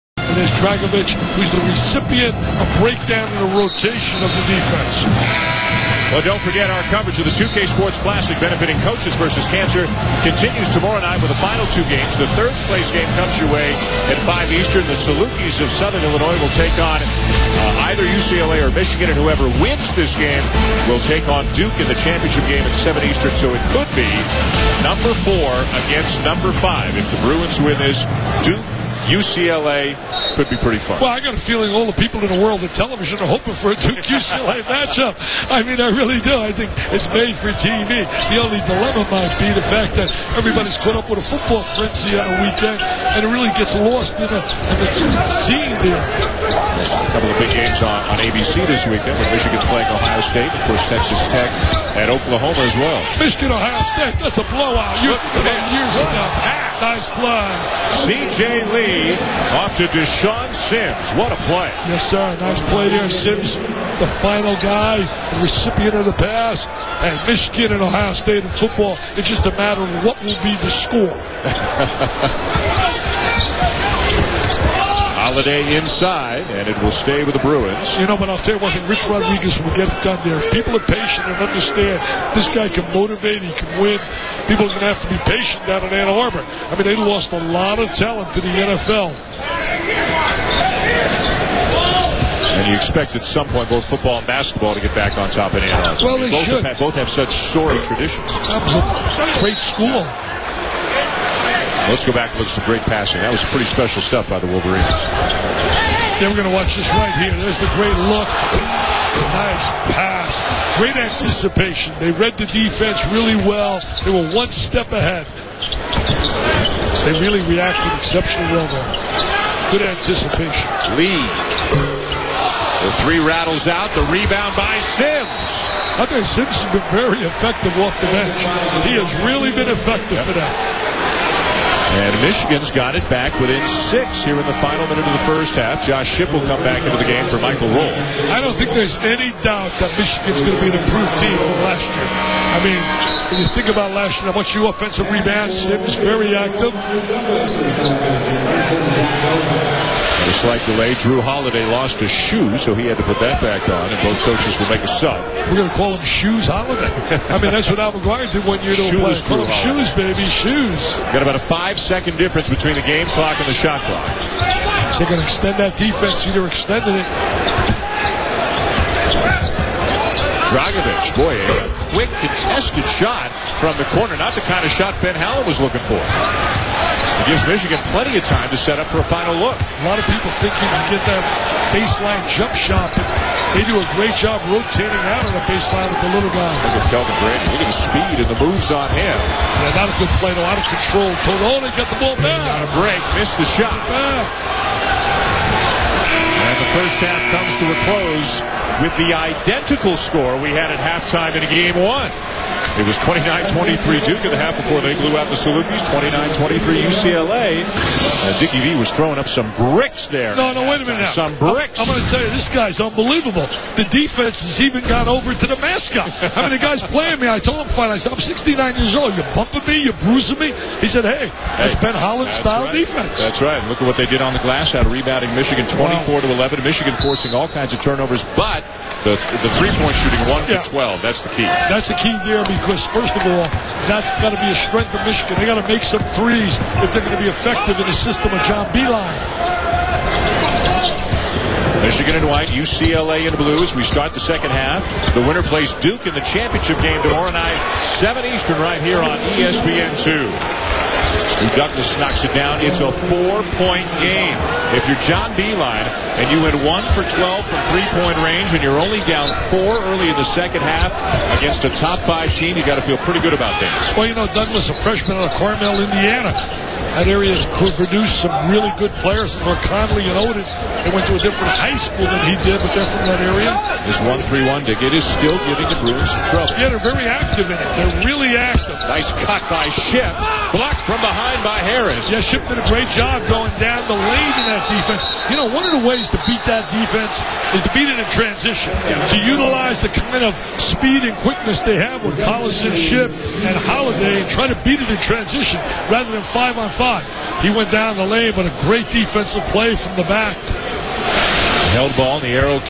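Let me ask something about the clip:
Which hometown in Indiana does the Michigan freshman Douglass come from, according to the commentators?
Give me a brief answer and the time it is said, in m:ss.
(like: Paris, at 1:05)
Carmel, Indiana, at 4:25.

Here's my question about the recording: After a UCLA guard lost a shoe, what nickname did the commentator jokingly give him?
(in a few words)
Shoes Holiday.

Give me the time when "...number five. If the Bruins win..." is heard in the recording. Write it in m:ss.
0:26.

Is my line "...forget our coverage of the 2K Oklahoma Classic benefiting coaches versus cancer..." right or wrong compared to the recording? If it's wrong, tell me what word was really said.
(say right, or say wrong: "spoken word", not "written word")
wrong: "Sports", not "Oklahoma".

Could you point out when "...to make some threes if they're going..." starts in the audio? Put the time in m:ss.
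3:55.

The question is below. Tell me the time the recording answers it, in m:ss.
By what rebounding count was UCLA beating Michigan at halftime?
3:45.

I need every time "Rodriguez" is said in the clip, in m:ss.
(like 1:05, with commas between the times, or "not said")
1:19.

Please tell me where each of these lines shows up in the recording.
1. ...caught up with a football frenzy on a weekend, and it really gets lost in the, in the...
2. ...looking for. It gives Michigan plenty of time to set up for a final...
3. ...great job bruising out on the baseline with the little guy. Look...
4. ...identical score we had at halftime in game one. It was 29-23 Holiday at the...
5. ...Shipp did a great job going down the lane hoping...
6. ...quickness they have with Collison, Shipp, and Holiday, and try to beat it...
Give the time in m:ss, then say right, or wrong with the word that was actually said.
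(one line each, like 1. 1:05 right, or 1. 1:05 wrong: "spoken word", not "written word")
1. 0:40 right
2. 2:55 right
3. 3:03 wrong: "rotating", not "bruising"
4. 3:19 wrong: "Duke", not "Holiday"
5. 4:42 wrong: "beating", not "hoping"
6. 4:51 right.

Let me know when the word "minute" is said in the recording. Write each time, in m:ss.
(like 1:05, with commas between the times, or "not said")
2:14, 3:30.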